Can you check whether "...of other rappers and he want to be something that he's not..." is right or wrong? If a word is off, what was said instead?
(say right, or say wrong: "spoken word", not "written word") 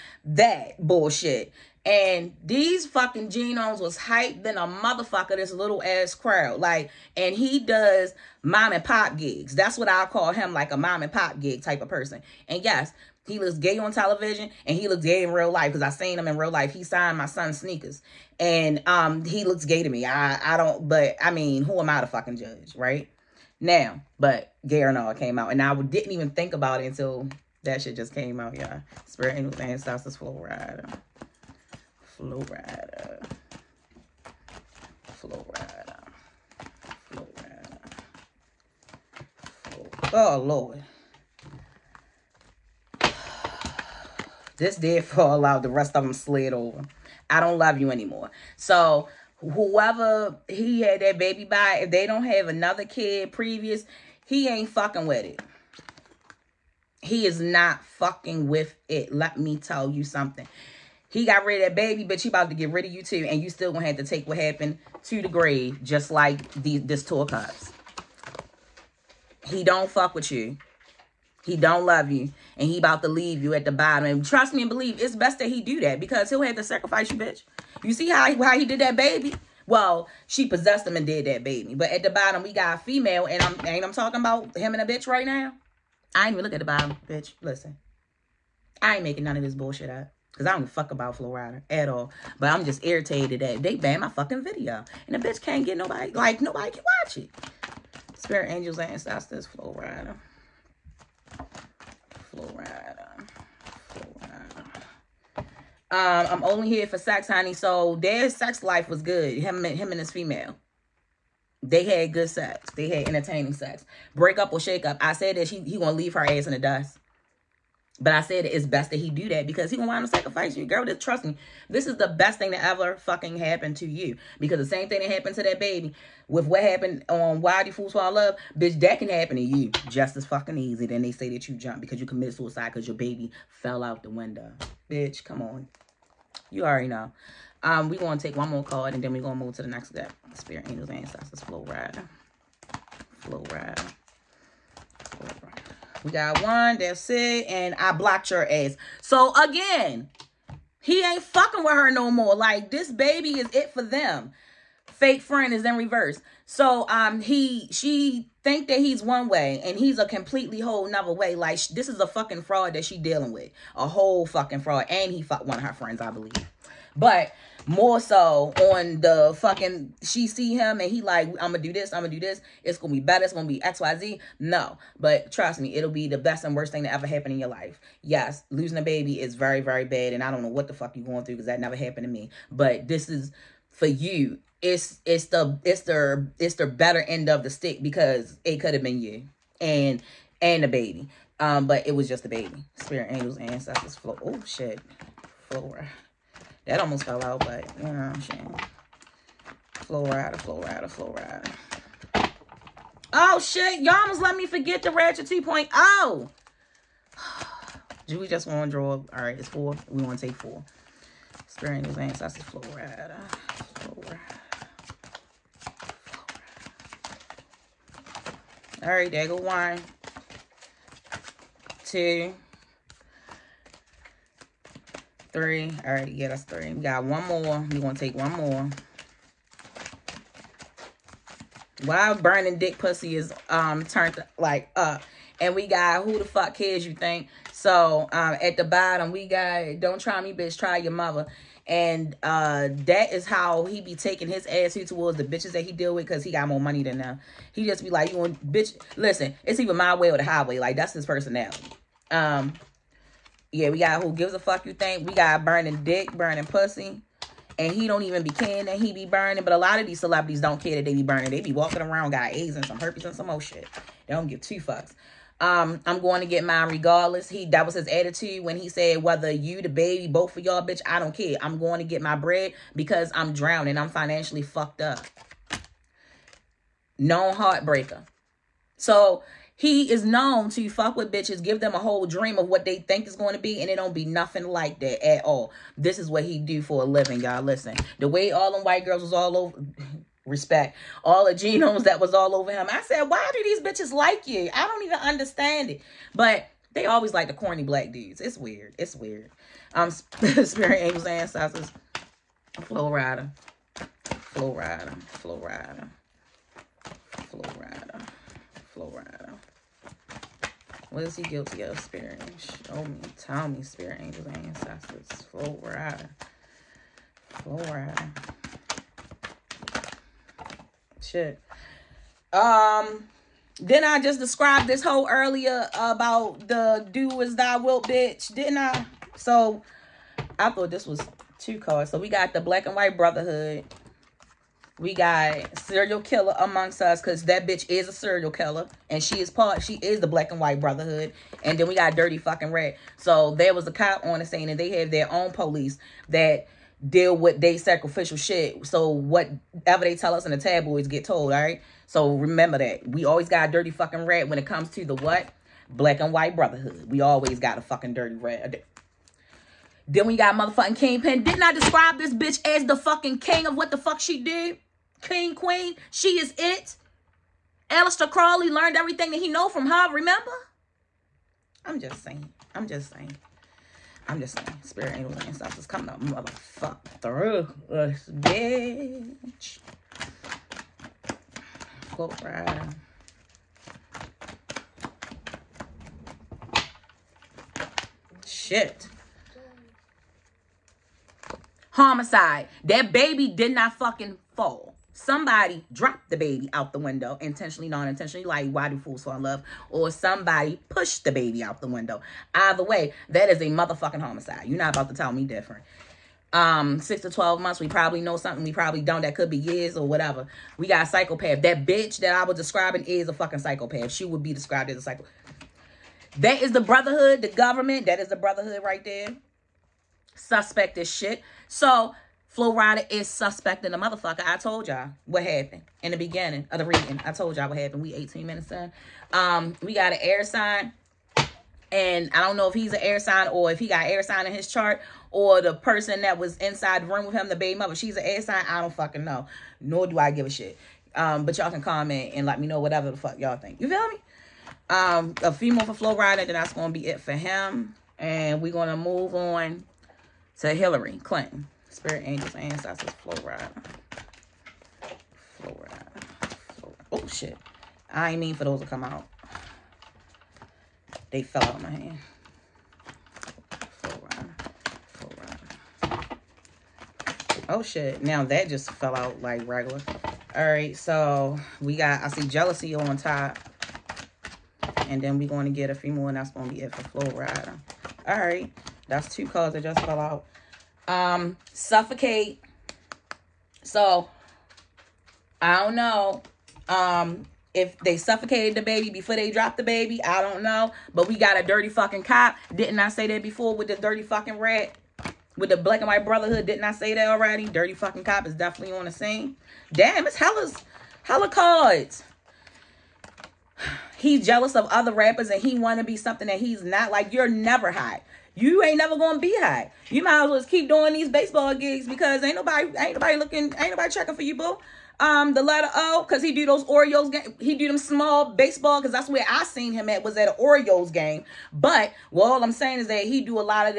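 right.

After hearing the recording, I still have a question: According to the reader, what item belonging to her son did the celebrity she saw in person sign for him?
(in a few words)
sneakers.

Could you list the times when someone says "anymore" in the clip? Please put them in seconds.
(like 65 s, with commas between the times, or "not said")
47 s.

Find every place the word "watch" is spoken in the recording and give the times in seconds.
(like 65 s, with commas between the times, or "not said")
97 s.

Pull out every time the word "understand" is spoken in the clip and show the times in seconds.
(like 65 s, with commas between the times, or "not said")
294 s.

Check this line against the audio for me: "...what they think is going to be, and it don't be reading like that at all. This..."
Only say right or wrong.
wrong.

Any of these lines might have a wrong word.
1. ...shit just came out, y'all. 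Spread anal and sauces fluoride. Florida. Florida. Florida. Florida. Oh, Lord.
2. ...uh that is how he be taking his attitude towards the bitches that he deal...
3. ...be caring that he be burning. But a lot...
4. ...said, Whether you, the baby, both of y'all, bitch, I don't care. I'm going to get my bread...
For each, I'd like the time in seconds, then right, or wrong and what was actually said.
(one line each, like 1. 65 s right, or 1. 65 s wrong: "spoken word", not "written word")
1. 27 s right
2. 242 s right
3. 258 s right
4. 268 s right.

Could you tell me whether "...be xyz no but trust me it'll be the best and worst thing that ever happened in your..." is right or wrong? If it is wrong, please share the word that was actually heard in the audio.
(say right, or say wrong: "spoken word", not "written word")
right.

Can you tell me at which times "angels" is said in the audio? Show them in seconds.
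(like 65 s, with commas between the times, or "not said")
98 s, 140 s, 193 s, 300 s, 313 s, 374 s, 452 s.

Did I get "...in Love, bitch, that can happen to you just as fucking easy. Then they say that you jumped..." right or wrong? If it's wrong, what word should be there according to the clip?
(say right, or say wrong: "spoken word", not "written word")
right.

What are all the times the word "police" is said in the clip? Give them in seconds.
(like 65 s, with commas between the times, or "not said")
345 s.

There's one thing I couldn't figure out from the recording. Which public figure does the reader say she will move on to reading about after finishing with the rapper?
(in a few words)
Hillary Clinton.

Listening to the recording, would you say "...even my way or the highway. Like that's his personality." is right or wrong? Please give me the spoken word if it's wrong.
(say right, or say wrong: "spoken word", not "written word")
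right.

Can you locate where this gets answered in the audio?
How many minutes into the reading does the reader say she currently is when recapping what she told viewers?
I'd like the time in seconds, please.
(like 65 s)
427 s.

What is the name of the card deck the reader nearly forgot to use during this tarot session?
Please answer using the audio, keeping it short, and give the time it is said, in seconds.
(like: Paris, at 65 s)
Ratchet 2.0, at 204 s.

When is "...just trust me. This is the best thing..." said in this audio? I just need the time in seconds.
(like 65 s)
120 s.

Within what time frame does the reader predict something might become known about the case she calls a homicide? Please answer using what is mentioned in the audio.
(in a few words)
6 to 12 months.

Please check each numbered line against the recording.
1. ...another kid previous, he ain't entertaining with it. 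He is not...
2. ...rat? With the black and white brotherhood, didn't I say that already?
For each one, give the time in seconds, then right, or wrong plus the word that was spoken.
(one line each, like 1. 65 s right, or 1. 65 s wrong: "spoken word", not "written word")
1. 52 s wrong: "fucking", not "entertaining"
2. 494 s right.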